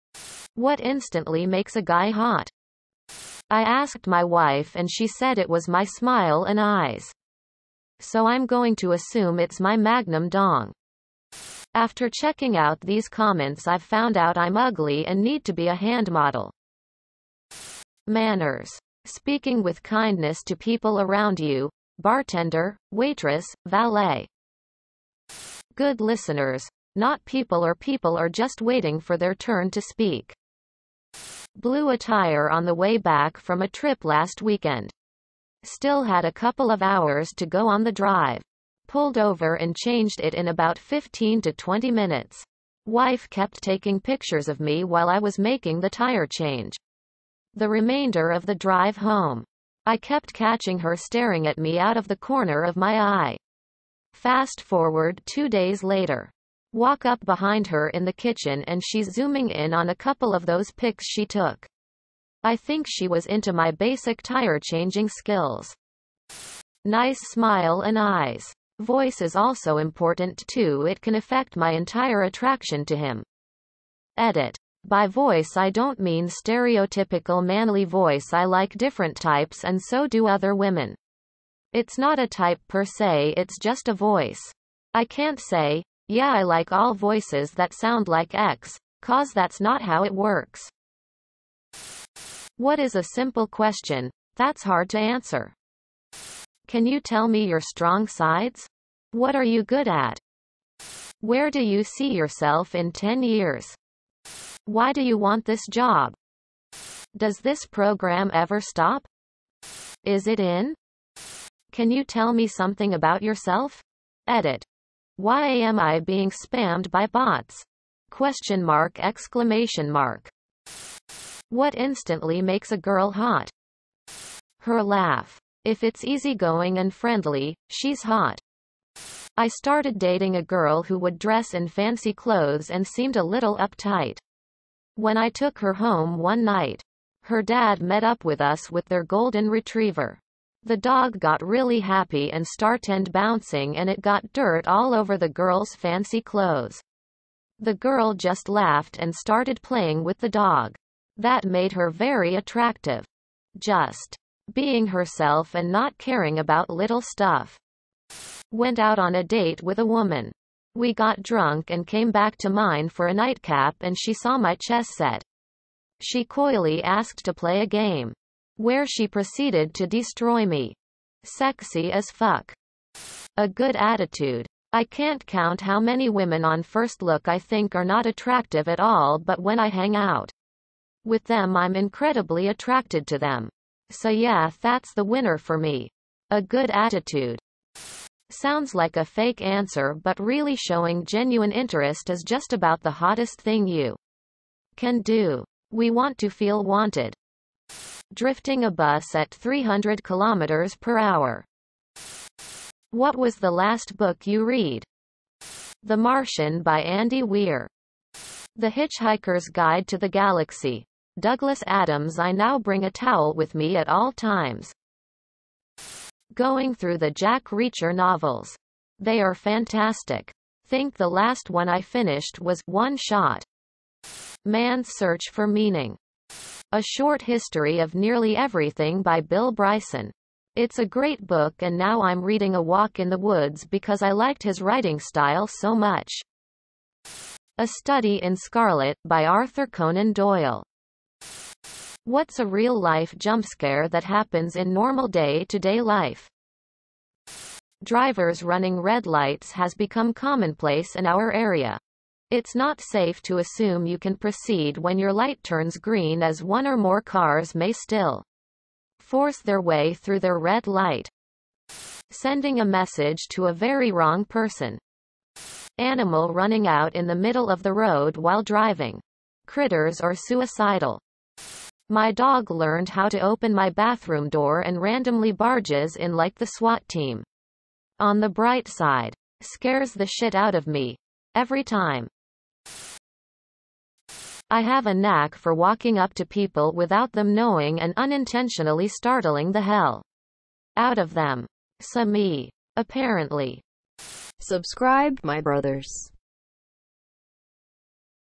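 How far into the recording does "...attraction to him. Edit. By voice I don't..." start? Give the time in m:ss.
1:12.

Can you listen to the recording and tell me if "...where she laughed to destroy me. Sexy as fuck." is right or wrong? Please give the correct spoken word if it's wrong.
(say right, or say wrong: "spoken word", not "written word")
wrong: "proceeded", not "laughed".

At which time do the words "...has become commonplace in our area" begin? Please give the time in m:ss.
4:09.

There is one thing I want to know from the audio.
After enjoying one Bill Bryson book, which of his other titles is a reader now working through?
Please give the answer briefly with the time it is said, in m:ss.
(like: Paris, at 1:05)
A Walk in the Woods, at 3:52.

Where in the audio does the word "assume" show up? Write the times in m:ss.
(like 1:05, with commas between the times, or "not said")
0:08, 4:13.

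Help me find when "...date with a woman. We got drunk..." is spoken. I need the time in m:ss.
2:39.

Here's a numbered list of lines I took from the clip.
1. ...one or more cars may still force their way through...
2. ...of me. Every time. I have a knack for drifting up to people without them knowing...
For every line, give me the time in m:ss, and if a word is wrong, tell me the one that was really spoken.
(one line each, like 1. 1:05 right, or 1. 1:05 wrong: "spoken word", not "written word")
1. 4:16 right
2. 4:40 wrong: "walking", not "drifting".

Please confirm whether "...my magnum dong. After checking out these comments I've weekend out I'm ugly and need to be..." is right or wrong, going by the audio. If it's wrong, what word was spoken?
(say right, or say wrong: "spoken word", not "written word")
wrong: "found", not "weekend".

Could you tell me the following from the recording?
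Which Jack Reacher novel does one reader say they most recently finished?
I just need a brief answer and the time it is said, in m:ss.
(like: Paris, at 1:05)
One Shot, at 3:42.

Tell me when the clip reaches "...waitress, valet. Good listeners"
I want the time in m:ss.
0:22.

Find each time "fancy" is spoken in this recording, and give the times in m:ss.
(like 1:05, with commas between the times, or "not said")
2:11, 2:25.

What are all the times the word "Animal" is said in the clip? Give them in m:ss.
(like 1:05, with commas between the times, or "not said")
4:25.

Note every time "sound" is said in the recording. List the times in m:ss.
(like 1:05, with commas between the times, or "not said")
1:27, 3:08.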